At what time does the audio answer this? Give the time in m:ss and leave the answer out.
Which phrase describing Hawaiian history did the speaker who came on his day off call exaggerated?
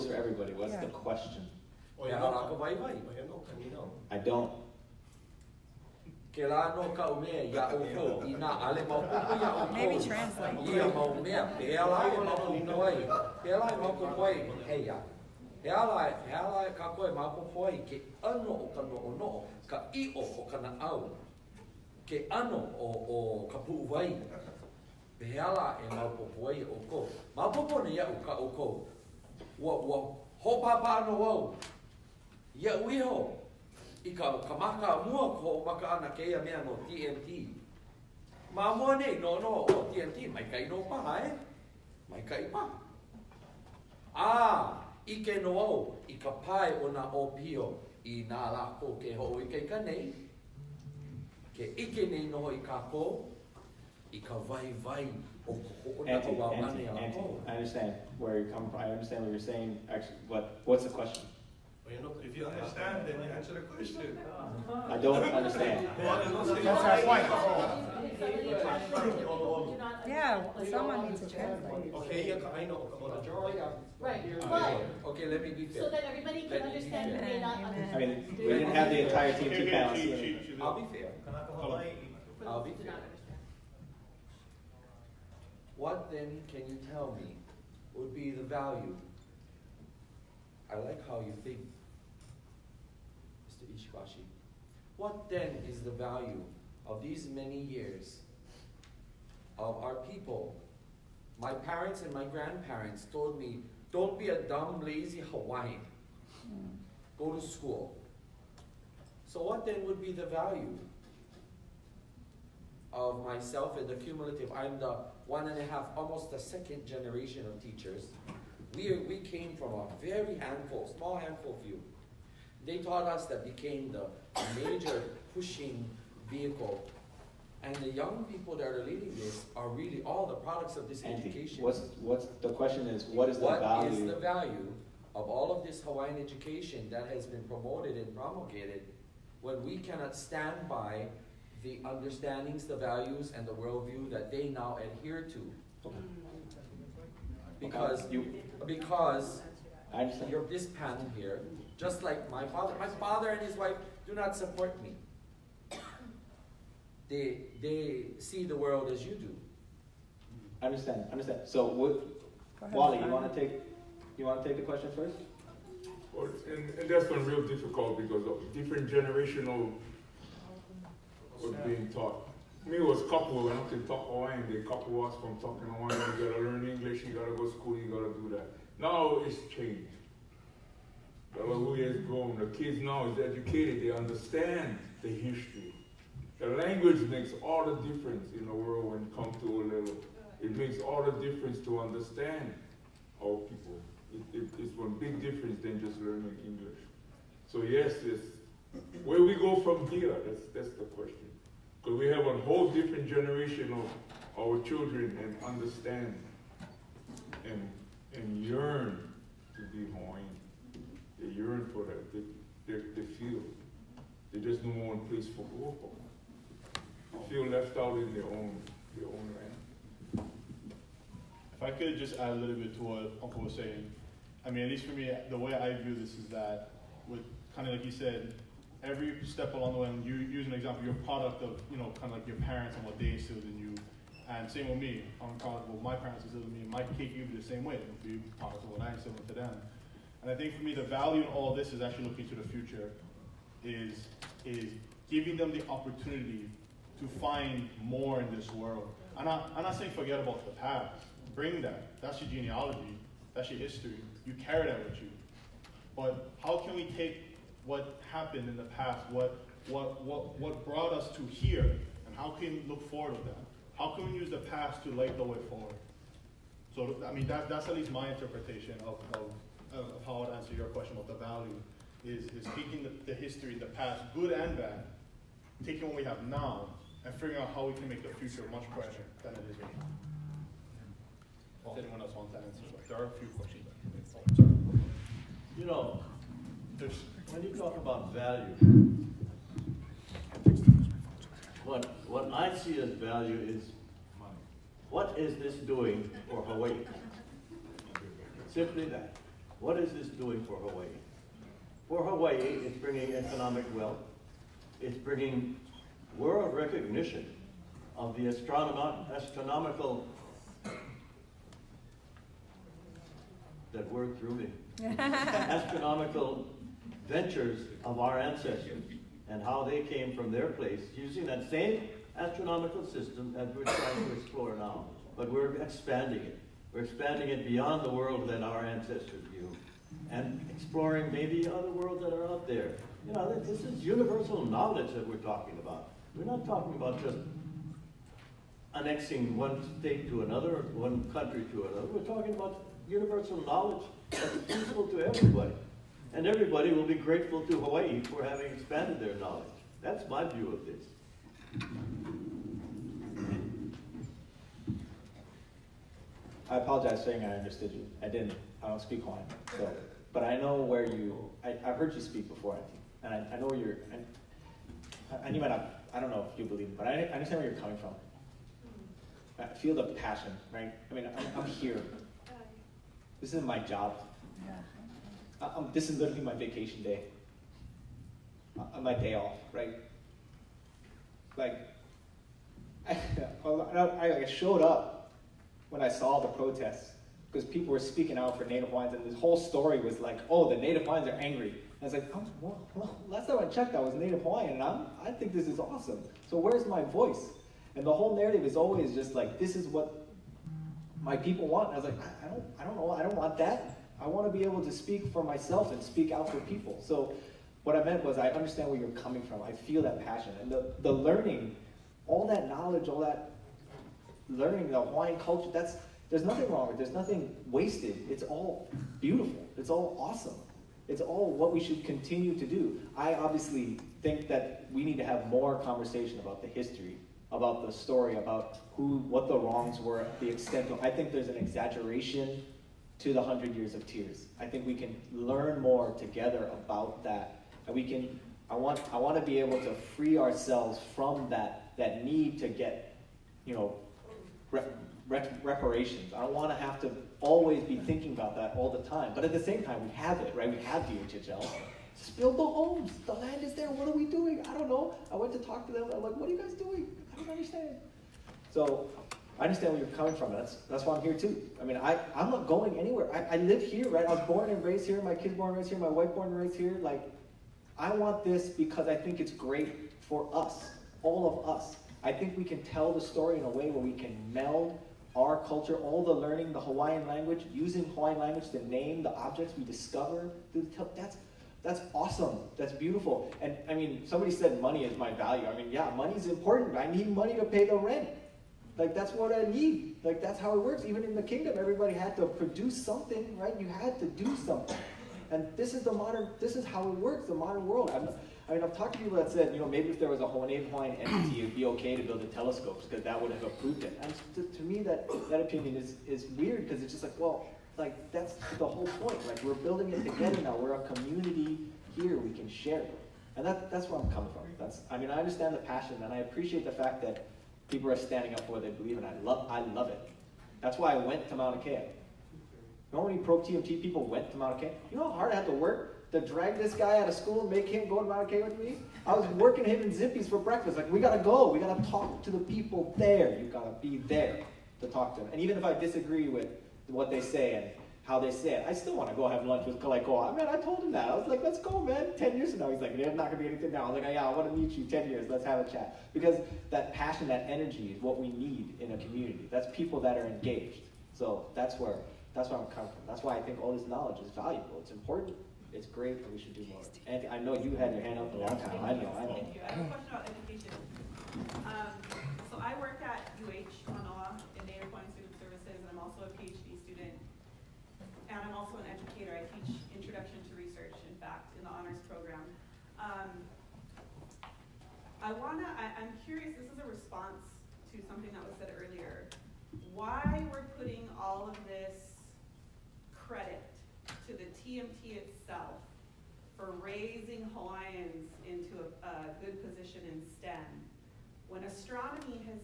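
7:13.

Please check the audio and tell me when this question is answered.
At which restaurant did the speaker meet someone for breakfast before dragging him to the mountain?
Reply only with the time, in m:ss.
8:49.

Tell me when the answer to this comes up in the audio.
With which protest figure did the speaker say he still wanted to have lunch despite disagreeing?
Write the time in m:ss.
8:59.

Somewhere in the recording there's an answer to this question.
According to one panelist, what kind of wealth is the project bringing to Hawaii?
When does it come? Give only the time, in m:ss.
5:03.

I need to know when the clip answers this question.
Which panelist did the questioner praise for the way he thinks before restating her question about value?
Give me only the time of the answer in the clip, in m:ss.
1:33.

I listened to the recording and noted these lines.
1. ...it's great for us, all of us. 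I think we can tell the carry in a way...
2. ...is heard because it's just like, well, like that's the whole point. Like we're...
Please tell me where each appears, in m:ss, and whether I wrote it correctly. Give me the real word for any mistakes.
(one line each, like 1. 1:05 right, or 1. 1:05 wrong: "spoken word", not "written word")
1. 7:49 wrong: "story", not "carry"
2. 8:26 wrong: "weird", not "heard".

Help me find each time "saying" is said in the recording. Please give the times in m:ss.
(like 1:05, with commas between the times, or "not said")
0:59, 3:43, 4:09, 5:57.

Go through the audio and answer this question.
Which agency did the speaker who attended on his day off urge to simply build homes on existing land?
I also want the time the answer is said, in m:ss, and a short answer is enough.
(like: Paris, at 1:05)
DHHL, at 7:30.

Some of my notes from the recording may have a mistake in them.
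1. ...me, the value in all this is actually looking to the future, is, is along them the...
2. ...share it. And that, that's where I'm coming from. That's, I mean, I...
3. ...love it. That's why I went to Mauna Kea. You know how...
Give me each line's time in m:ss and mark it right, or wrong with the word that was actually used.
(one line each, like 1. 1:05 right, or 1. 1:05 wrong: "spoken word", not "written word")
1. 4:00 wrong: "giving", not "along"
2. 8:32 right
3. 8:39 right.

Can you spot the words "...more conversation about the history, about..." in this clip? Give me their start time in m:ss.
7:05.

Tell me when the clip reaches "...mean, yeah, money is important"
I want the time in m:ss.
8:05.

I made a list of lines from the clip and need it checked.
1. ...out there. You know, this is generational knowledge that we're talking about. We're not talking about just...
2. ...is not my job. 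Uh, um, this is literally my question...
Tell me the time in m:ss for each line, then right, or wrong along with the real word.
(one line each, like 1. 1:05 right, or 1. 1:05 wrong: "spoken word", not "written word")
1. 5:32 wrong: "universal", not "generational"
2. 6:13 wrong: "vacation", not "question".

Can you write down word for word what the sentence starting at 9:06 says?
Because that passion, that energy is what we need in a community.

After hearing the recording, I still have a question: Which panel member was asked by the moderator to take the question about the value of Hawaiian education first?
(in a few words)
Wally.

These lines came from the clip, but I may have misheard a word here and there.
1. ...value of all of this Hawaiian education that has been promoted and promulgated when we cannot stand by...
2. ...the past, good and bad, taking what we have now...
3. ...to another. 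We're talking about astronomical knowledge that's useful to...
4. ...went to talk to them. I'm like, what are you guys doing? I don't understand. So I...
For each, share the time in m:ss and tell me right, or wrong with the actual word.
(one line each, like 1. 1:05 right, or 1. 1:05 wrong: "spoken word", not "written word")
1. 2:14 right
2. 4:33 right
3. 5:41 wrong: "universal", not "astronomical"
4. 7:35 right.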